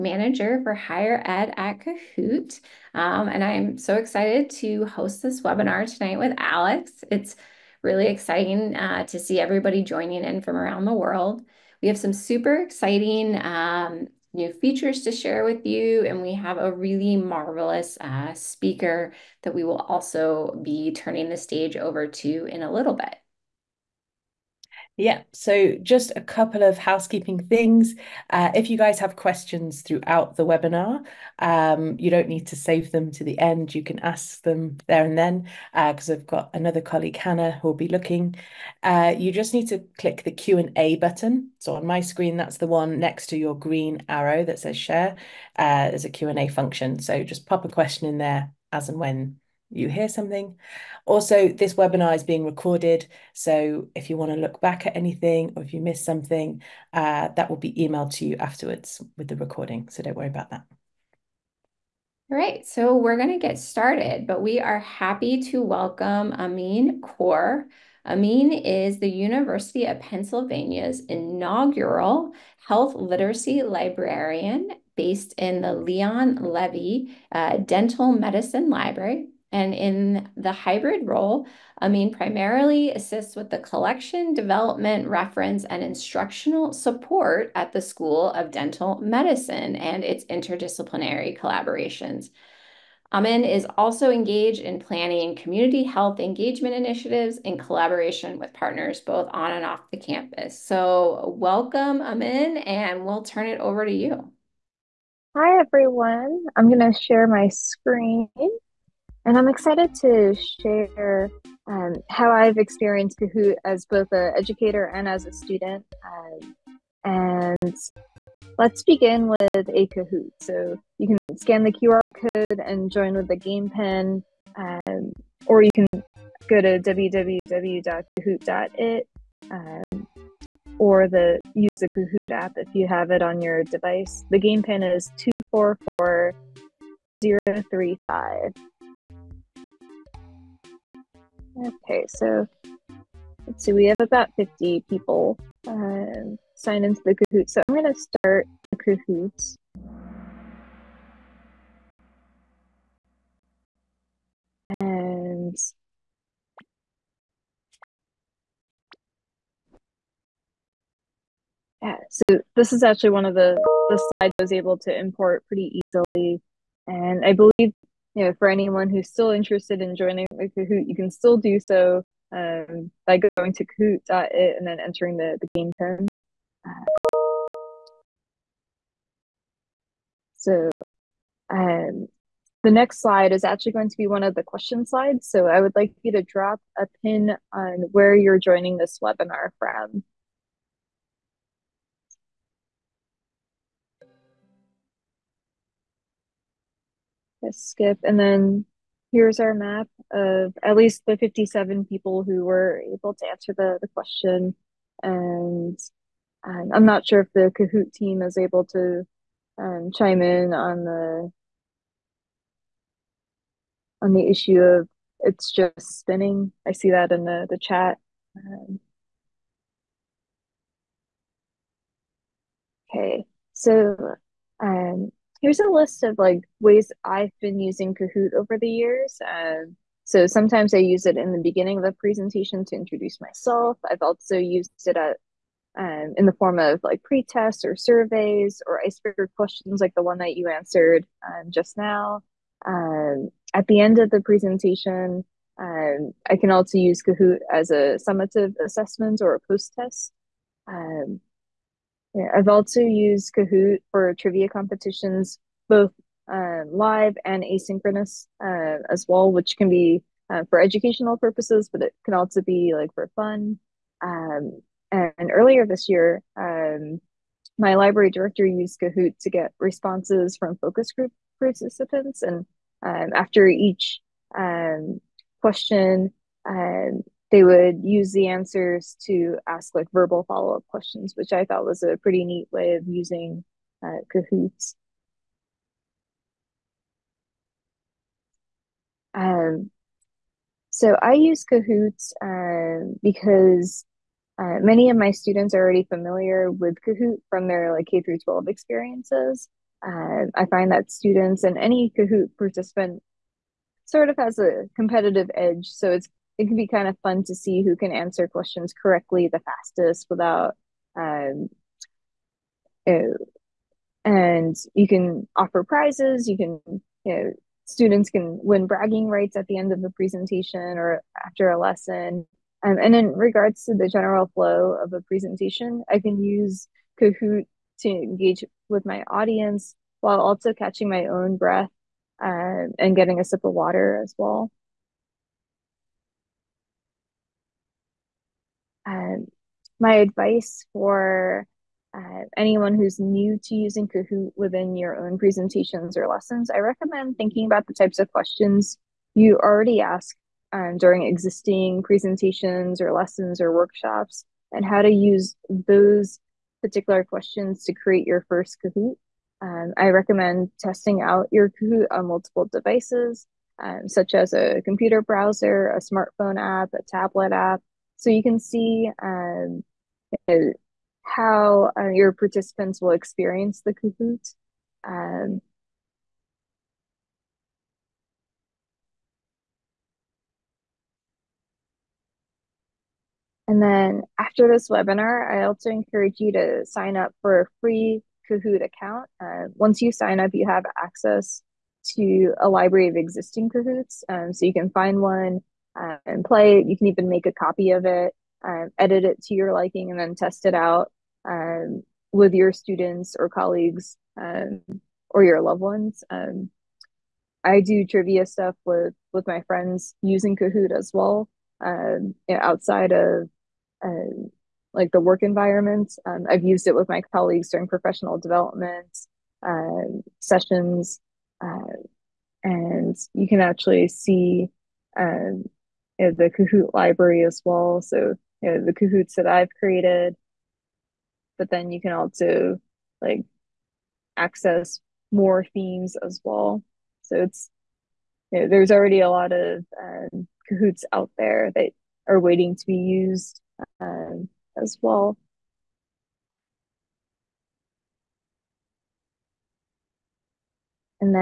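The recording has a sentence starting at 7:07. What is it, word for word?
So you know, the Kahoots that I've created, but then you can also like access more themes as well.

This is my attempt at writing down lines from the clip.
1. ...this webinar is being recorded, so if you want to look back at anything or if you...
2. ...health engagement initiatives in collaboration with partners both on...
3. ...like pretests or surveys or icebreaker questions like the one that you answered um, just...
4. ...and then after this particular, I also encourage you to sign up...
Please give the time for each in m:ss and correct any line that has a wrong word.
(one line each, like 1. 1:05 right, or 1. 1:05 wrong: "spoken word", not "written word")
1. 0:51 right
2. 1:35 right
3. 3:56 right
4. 6:23 wrong: "webinar", not "particular".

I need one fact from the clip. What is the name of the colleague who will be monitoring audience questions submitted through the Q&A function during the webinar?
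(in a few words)
Hannah.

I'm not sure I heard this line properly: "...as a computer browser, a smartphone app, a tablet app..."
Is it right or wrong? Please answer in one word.
right.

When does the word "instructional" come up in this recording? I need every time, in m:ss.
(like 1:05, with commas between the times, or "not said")
1:25.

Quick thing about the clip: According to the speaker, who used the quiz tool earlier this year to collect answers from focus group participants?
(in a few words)
Library director.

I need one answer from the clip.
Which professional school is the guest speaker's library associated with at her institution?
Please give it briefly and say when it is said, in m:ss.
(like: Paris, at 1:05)
School of Dental Medicine, at 1:27.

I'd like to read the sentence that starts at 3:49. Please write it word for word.
Um, so sometimes I use it in the beginning of a presentation to introduce myself.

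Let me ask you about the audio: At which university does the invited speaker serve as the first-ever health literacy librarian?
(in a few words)
University of Pennsylvania.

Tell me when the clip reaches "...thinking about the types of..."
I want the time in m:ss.
5:47.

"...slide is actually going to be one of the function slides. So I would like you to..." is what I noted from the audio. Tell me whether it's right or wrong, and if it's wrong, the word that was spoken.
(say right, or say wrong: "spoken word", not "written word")
wrong: "question", not "function".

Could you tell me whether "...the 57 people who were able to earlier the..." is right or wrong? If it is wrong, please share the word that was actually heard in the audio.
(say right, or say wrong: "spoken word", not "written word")
wrong: "answer", not "earlier".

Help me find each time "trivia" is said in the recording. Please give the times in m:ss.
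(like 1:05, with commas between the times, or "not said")
4:14, 6:47.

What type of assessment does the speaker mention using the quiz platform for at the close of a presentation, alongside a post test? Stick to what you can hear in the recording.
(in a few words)
Summative assessment.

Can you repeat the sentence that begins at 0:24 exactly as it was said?
Yeah, so just a couple of housekeeping things.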